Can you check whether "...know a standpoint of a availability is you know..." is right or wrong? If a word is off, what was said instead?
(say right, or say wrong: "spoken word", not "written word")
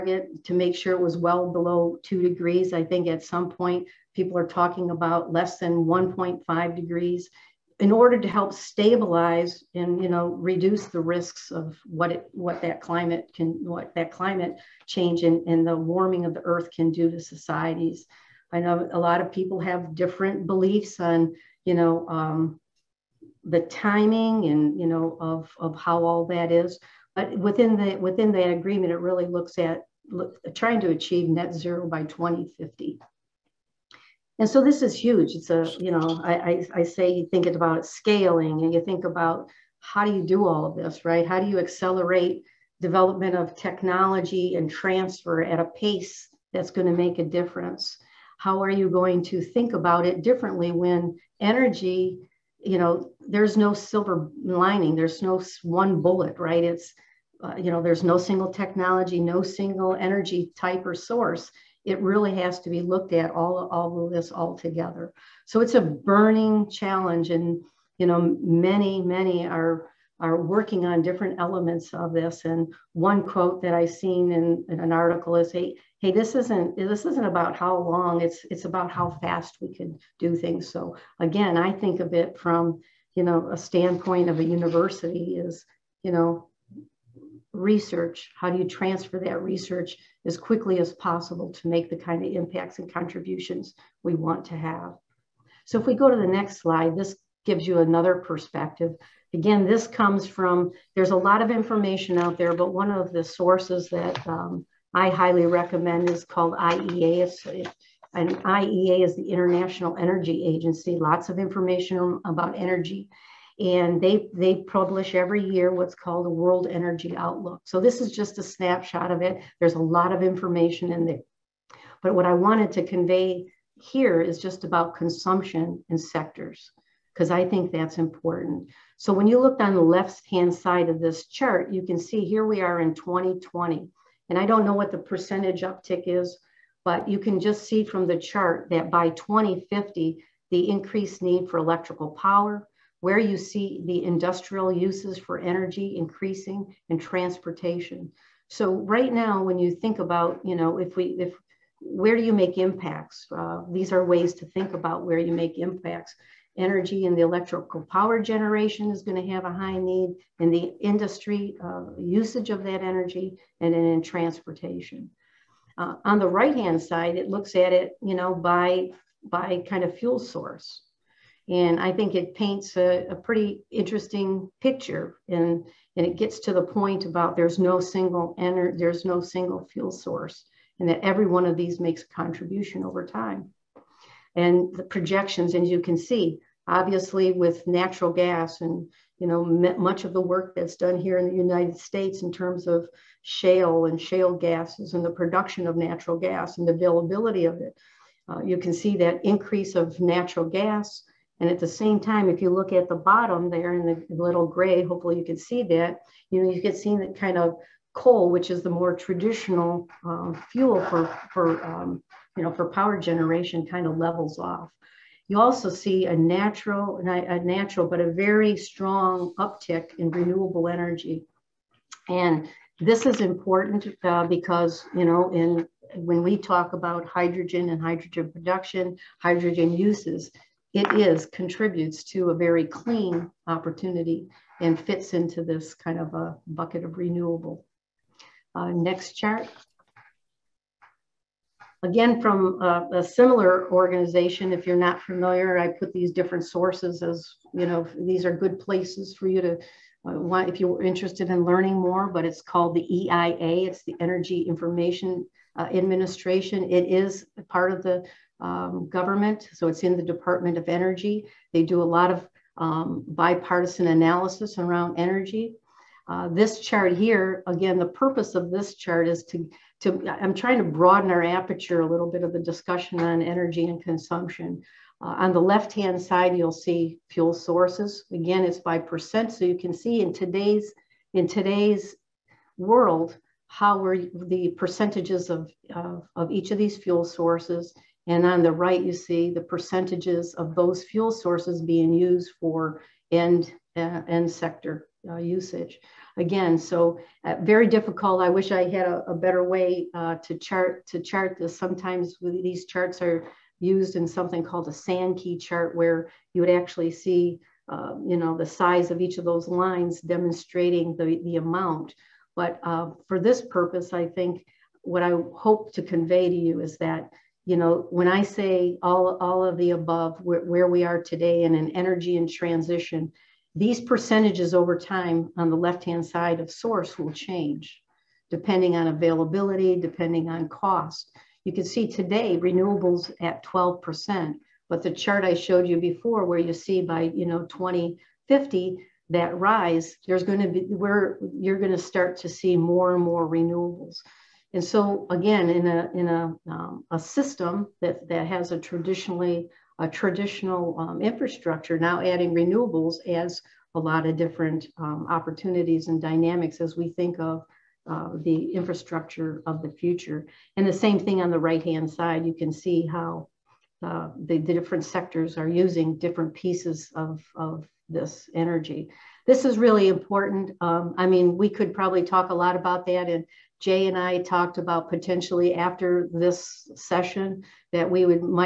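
wrong: "university", not "availability".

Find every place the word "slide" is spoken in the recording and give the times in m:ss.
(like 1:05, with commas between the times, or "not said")
1:36.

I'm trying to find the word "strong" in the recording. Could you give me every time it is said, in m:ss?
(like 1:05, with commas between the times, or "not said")
3:38.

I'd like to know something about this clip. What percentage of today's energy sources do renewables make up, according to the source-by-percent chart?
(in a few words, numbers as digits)
12%.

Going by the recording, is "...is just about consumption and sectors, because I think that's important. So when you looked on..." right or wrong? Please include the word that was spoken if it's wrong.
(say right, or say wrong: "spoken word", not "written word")
right.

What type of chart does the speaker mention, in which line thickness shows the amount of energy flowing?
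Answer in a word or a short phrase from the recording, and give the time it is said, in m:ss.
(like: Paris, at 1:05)
Sankey chart, at 5:04.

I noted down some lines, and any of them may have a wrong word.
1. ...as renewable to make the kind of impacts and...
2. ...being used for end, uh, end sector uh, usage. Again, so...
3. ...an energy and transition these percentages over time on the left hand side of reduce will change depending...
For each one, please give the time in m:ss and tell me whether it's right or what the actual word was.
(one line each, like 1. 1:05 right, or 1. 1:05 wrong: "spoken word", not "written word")
1. 1:30 wrong: "possible", not "renewable"
2. 4:51 right
3. 5:21 wrong: "source", not "reduce".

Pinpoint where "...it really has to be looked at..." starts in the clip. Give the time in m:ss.
1:01.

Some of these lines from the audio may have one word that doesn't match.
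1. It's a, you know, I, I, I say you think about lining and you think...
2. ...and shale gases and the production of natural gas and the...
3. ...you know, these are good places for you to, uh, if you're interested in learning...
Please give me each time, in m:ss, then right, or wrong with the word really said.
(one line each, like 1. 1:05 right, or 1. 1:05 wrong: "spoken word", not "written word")
1. 0:35 wrong: "scaling", not "lining"
2. 3:13 right
3. 4:07 right.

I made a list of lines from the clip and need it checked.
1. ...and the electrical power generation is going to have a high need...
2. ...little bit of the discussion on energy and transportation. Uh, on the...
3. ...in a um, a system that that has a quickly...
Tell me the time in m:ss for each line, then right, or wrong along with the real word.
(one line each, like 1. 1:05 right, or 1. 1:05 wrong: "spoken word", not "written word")
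1. 2:37 right
2. 4:31 wrong: "consumption", not "transportation"
3. 5:45 wrong: "traditionally", not "quickly".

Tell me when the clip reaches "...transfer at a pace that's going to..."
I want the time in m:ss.
0:44.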